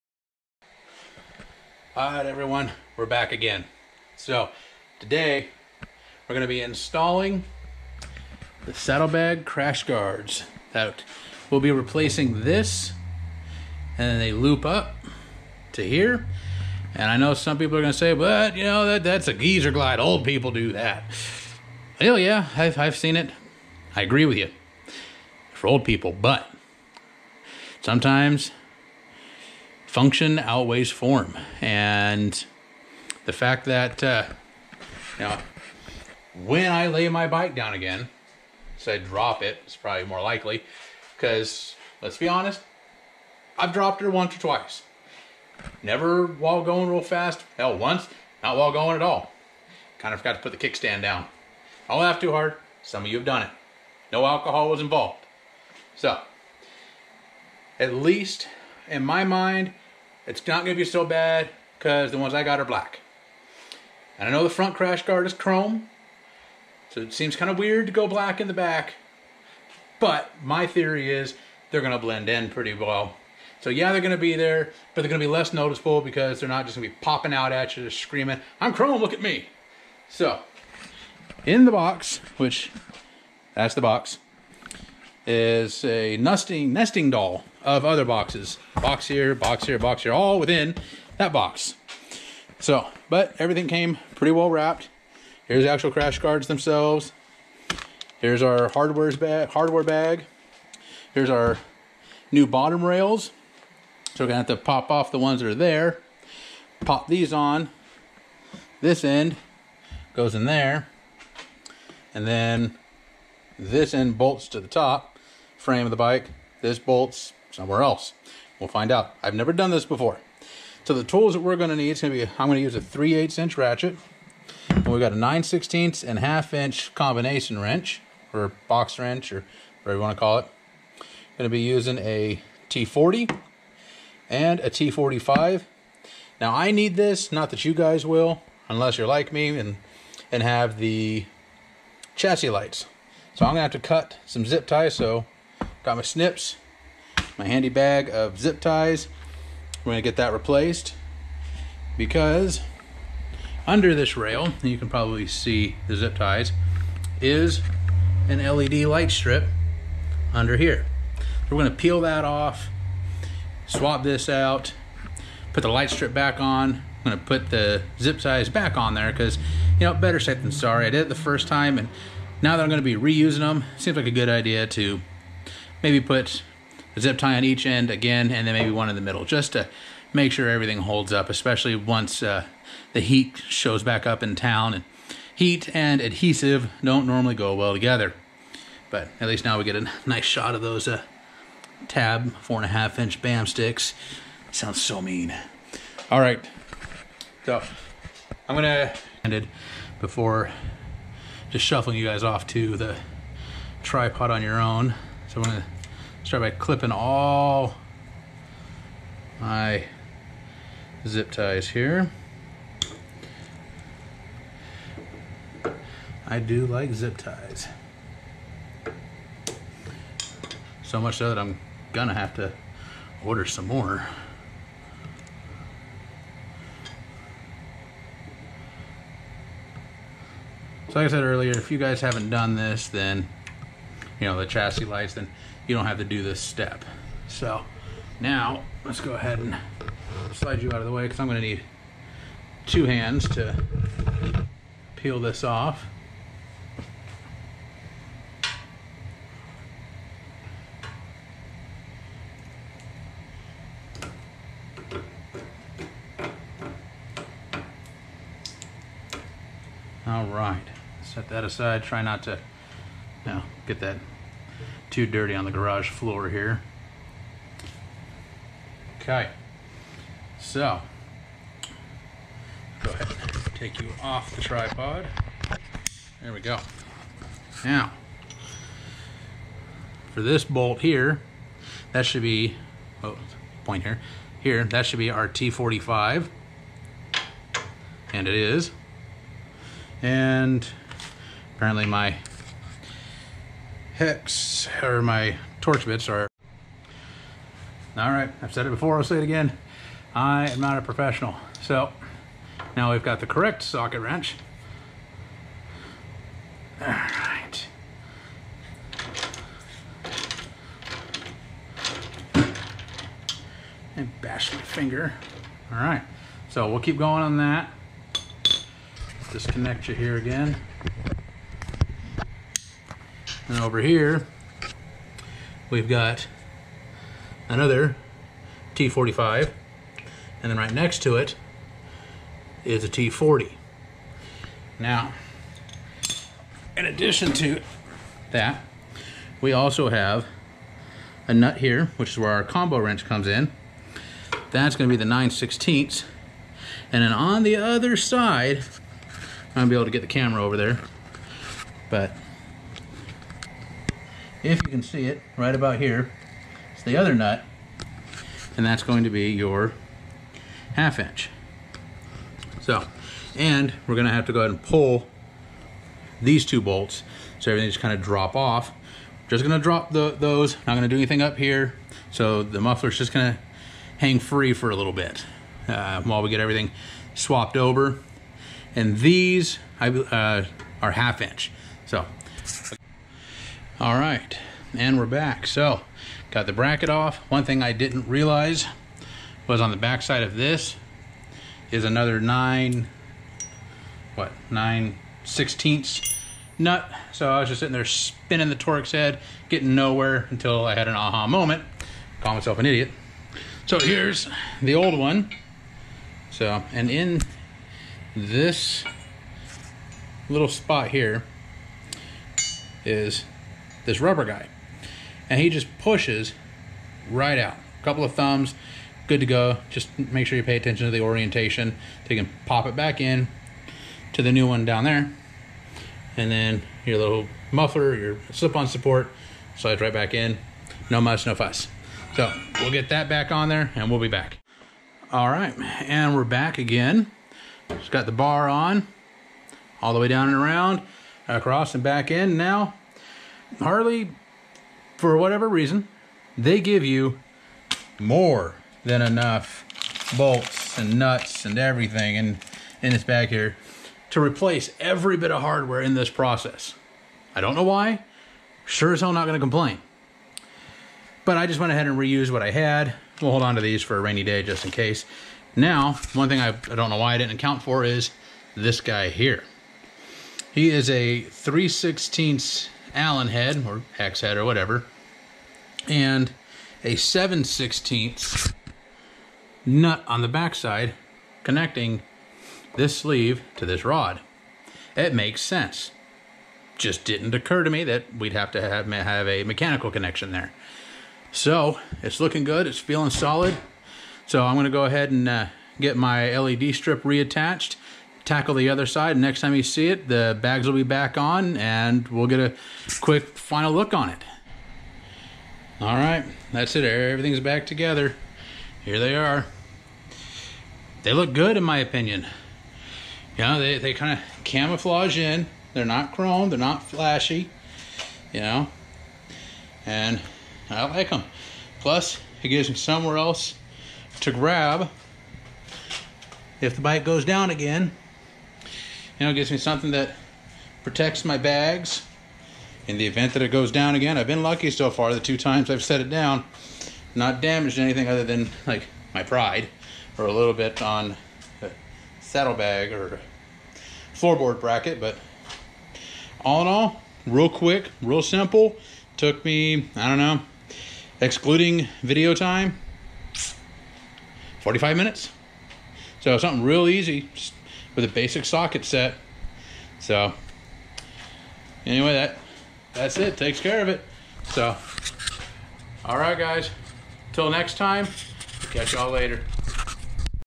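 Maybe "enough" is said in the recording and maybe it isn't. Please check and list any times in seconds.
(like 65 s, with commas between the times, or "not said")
449 s.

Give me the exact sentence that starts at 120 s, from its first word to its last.
So the tools that we're going to need is going to be, I'm going to use a 3 8 inch ratchet.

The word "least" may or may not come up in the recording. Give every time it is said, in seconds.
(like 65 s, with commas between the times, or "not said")
57 s, 189 s.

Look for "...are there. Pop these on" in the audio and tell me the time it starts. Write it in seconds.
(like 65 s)
105 s.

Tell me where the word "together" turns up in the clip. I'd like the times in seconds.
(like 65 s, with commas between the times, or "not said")
187 s, 507 s.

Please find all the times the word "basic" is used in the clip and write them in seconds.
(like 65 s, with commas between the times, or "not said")
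558 s.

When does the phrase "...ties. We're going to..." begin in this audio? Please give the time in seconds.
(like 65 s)
148 s.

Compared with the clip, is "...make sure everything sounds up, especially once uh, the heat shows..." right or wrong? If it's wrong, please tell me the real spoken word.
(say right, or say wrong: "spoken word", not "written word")
wrong: "holds", not "sounds".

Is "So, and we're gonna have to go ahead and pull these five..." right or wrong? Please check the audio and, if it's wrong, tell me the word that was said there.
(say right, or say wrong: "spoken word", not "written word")
wrong: "two", not "five".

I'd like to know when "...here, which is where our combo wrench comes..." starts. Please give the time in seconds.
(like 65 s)
341 s.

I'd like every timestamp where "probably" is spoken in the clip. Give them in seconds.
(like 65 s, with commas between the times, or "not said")
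39 s, 154 s.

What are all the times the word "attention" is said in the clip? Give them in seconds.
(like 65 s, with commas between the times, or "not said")
420 s.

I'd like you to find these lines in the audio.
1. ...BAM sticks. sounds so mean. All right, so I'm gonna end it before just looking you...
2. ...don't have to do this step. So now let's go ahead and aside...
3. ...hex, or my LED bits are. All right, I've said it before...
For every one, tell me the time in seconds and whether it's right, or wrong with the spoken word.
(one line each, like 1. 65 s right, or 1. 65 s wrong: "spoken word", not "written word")
1. 193 s wrong: "shuffling", not "looking"
2. 235 s wrong: "slide", not "aside"
3. 294 s wrong: "Torx", not "LED".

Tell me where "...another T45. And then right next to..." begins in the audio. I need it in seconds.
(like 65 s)
327 s.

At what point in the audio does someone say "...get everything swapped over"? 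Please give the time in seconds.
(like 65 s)
376 s.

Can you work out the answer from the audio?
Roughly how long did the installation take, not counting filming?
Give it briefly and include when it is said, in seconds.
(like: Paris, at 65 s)
45 minutes, at 554 s.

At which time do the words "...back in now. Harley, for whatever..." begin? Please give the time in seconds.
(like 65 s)
441 s.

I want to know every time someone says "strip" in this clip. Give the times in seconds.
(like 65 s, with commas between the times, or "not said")
159 s, 165 s, 496 s.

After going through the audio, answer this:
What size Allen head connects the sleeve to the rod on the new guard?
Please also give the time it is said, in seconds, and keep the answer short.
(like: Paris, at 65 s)
3/16, at 471 s.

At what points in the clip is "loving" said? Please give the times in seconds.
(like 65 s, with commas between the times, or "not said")
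not said.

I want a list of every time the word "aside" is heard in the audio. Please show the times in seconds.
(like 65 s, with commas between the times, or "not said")
261 s.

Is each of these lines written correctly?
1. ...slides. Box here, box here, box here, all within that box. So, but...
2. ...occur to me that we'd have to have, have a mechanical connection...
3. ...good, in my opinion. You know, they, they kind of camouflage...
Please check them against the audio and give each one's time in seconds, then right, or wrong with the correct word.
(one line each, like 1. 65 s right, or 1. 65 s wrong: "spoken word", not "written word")
1. 88 s wrong: "boxes", not "slides"
2. 487 s right
3. 511 s right.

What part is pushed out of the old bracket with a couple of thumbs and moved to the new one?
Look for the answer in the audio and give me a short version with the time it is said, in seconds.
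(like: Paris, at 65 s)
Rubber guy, at 414 s.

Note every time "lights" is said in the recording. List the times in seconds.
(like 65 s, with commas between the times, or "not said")
142 s, 158 s, 165 s, 234 s.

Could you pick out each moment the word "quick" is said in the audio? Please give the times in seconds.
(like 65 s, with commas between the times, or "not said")
502 s, 547 s.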